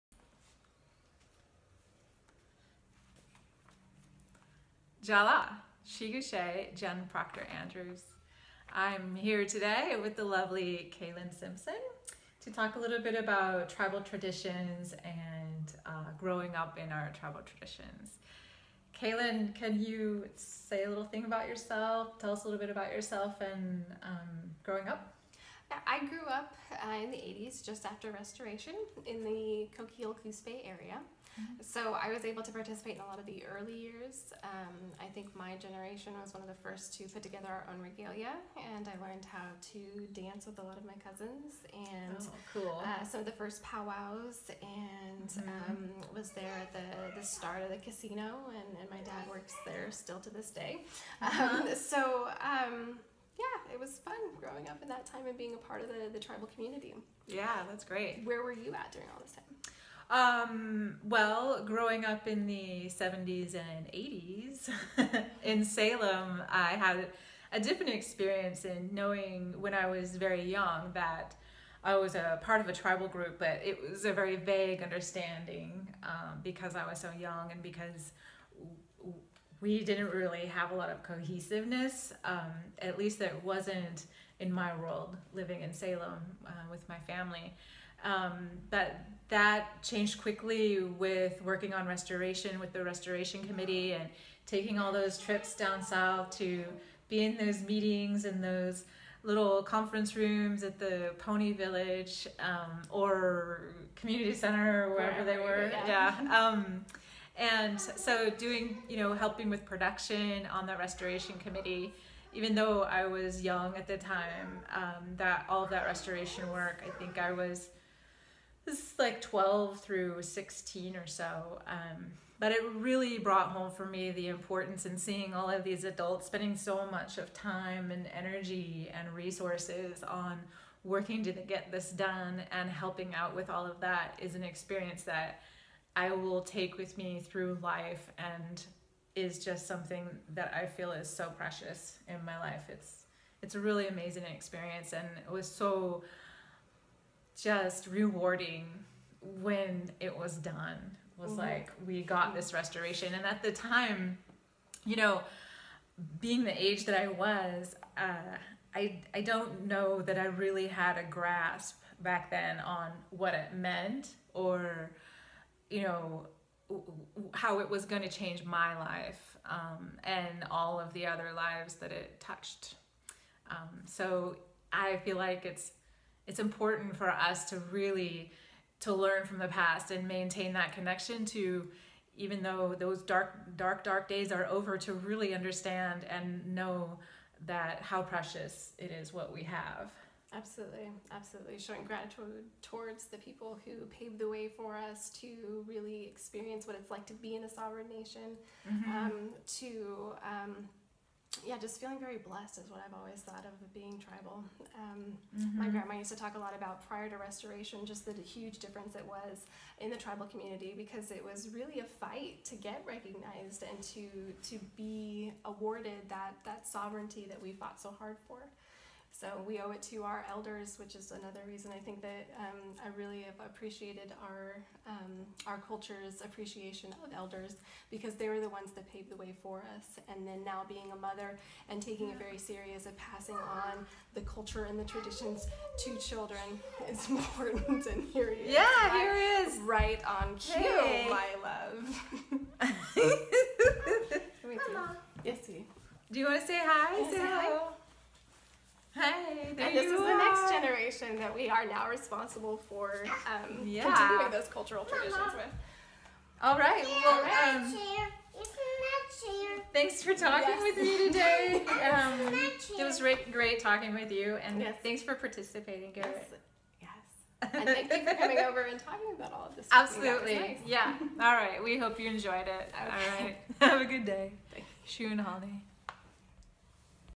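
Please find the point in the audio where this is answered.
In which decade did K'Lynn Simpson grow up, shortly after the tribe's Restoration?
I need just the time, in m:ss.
0:27.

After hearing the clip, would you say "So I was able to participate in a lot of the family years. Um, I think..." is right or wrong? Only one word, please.
wrong.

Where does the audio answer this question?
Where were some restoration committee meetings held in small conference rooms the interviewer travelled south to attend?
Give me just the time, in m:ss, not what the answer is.
1:40.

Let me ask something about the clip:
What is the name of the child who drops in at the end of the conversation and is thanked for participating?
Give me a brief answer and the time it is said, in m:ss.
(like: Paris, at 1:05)
Garrett, at 4:25.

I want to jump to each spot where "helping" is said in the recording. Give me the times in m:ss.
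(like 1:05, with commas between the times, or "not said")
1:49, 2:12.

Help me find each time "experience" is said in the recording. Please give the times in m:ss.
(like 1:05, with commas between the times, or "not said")
1:07, 2:14, 2:24, 3:16.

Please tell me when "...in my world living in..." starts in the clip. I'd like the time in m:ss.
1:24.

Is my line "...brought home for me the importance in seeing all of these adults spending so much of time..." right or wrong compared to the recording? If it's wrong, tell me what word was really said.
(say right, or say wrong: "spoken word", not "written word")
right.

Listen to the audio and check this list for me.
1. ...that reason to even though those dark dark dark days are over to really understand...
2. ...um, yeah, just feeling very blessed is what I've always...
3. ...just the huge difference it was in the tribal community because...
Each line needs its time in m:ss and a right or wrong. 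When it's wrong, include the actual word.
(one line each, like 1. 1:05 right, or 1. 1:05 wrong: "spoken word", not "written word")
1. 3:00 wrong: "connection", not "reason"
2. 3:20 right
3. 3:27 right.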